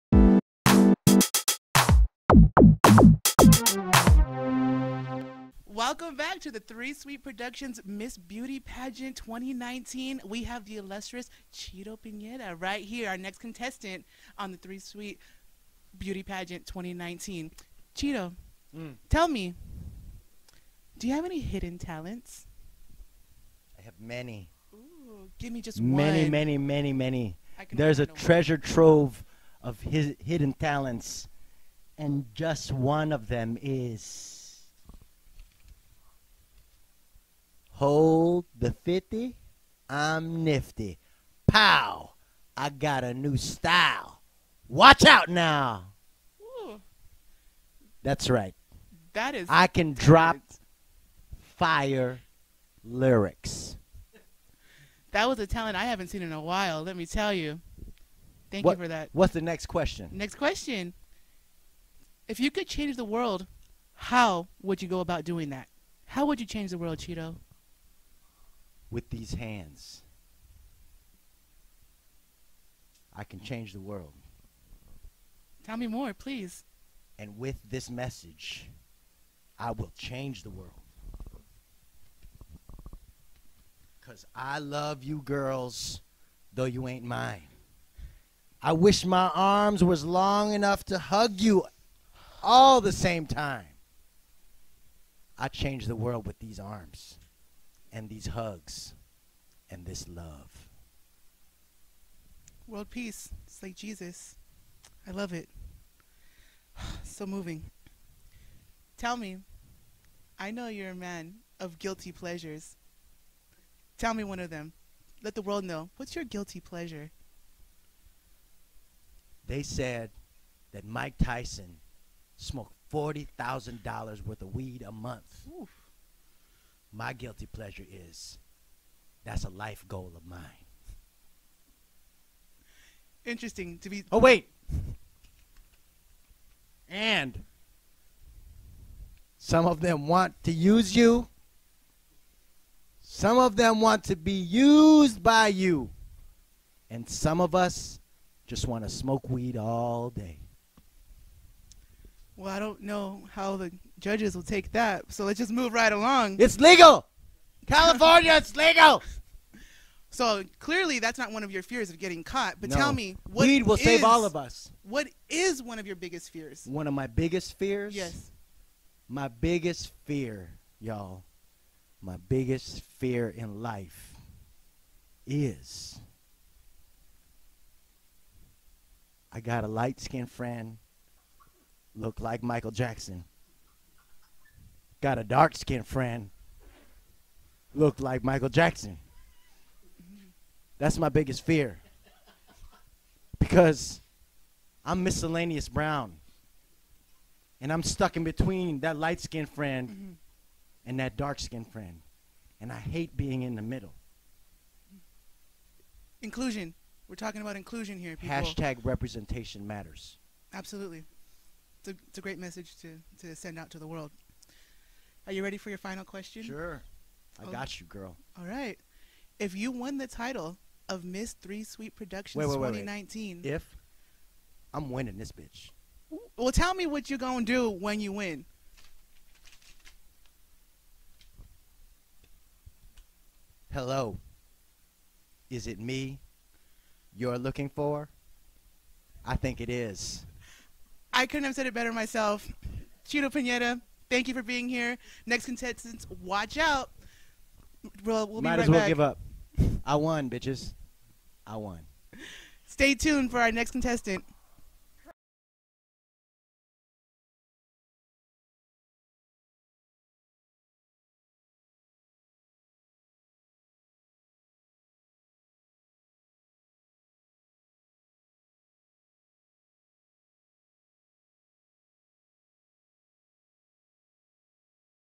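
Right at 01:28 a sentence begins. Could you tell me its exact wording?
I wish my arms was long enough to hug you all the same time.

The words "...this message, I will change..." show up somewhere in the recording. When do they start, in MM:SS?
01:17.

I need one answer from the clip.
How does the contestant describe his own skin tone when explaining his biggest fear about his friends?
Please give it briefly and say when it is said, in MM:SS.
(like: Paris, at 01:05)
miscellaneous brown, at 03:15.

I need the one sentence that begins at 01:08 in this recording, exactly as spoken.
with these hands, I can change the world.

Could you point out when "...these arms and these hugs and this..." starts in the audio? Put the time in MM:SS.
01:36.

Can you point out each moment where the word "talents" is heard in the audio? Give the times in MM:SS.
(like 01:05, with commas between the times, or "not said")
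00:21, 00:30, 00:55.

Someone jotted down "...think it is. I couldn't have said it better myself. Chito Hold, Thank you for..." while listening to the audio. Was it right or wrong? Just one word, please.
wrong.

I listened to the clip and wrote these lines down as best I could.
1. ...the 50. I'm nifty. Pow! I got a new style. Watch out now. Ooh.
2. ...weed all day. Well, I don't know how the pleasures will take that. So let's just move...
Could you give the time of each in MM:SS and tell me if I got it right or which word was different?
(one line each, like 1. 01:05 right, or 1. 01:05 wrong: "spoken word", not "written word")
1. 00:38 right
2. 02:29 wrong: "judges", not "pleasures".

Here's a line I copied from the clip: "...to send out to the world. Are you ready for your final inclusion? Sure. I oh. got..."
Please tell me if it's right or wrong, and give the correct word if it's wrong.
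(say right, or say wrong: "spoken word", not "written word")
wrong: "question", not "inclusion".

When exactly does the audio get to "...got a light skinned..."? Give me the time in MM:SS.
02:59.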